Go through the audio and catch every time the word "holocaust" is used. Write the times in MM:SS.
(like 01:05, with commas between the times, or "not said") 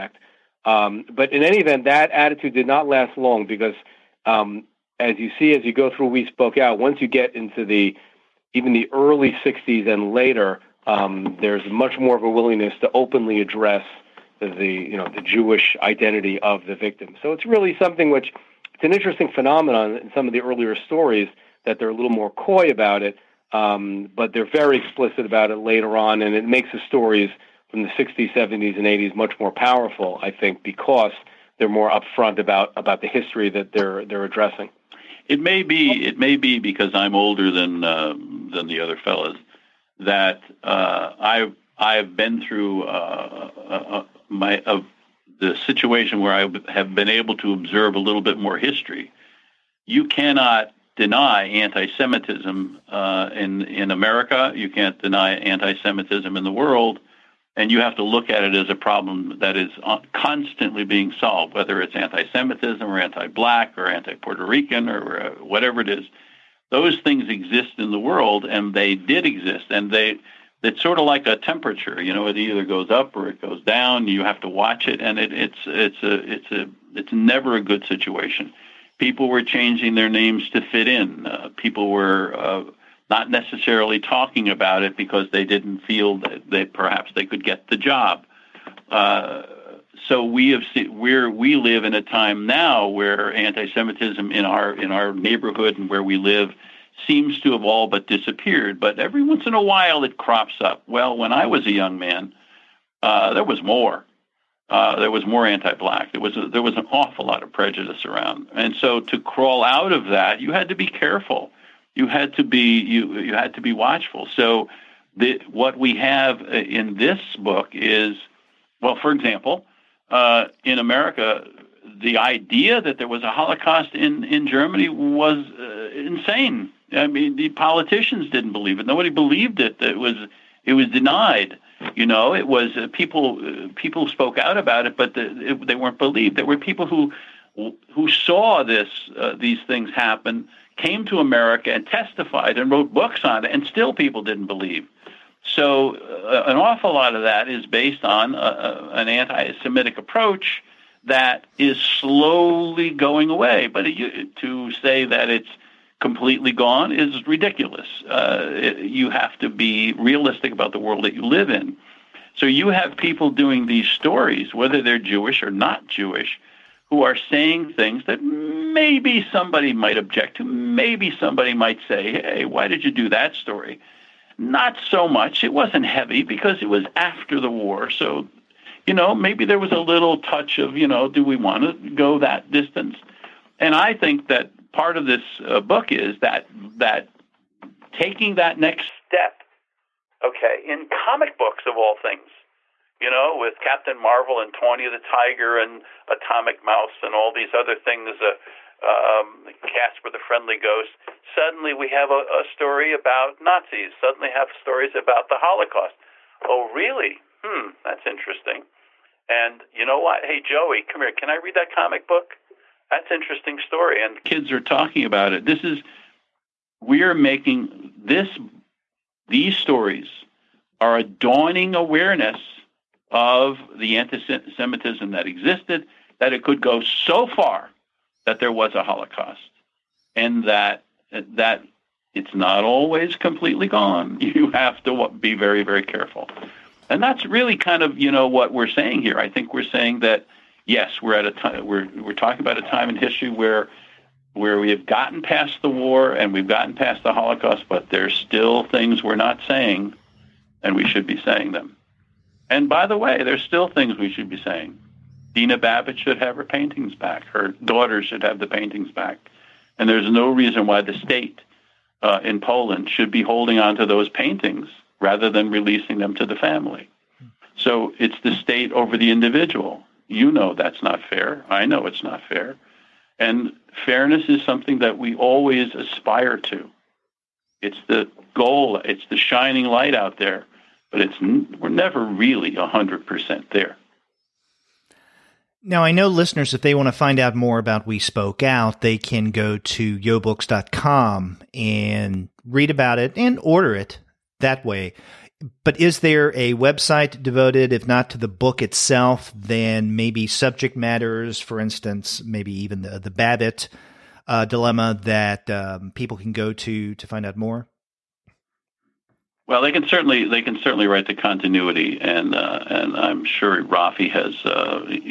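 02:03, 03:25, 03:48, 04:07.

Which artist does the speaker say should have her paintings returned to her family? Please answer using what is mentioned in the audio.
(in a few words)
Dina Babbitt.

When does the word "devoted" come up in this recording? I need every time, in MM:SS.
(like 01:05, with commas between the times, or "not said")
04:57.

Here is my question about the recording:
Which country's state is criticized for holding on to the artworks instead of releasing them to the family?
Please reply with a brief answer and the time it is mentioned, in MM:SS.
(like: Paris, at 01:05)
Poland, at 04:22.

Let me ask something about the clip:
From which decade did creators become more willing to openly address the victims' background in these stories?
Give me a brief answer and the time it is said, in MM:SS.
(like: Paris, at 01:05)
early '60s, at 00:08.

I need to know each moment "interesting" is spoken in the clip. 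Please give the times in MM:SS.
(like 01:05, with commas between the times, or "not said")
00:18, 03:28, 03:33.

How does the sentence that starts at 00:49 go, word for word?
You cannot deny anti-Semitism uh, in in America.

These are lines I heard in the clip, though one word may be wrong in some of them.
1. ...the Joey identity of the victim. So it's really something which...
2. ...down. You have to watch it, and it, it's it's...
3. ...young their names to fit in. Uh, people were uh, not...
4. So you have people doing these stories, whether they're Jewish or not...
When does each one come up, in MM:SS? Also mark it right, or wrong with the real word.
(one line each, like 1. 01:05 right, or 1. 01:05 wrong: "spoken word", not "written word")
1. 00:15 wrong: "Jewish", not "Joey"
2. 01:13 right
3. 01:19 wrong: "changing", not "young"
4. 02:42 right.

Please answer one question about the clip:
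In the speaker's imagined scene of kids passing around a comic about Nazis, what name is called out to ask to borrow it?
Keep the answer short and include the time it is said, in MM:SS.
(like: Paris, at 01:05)
Joey, at 03:30.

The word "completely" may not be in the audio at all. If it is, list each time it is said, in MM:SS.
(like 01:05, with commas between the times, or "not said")
02:36, 03:53.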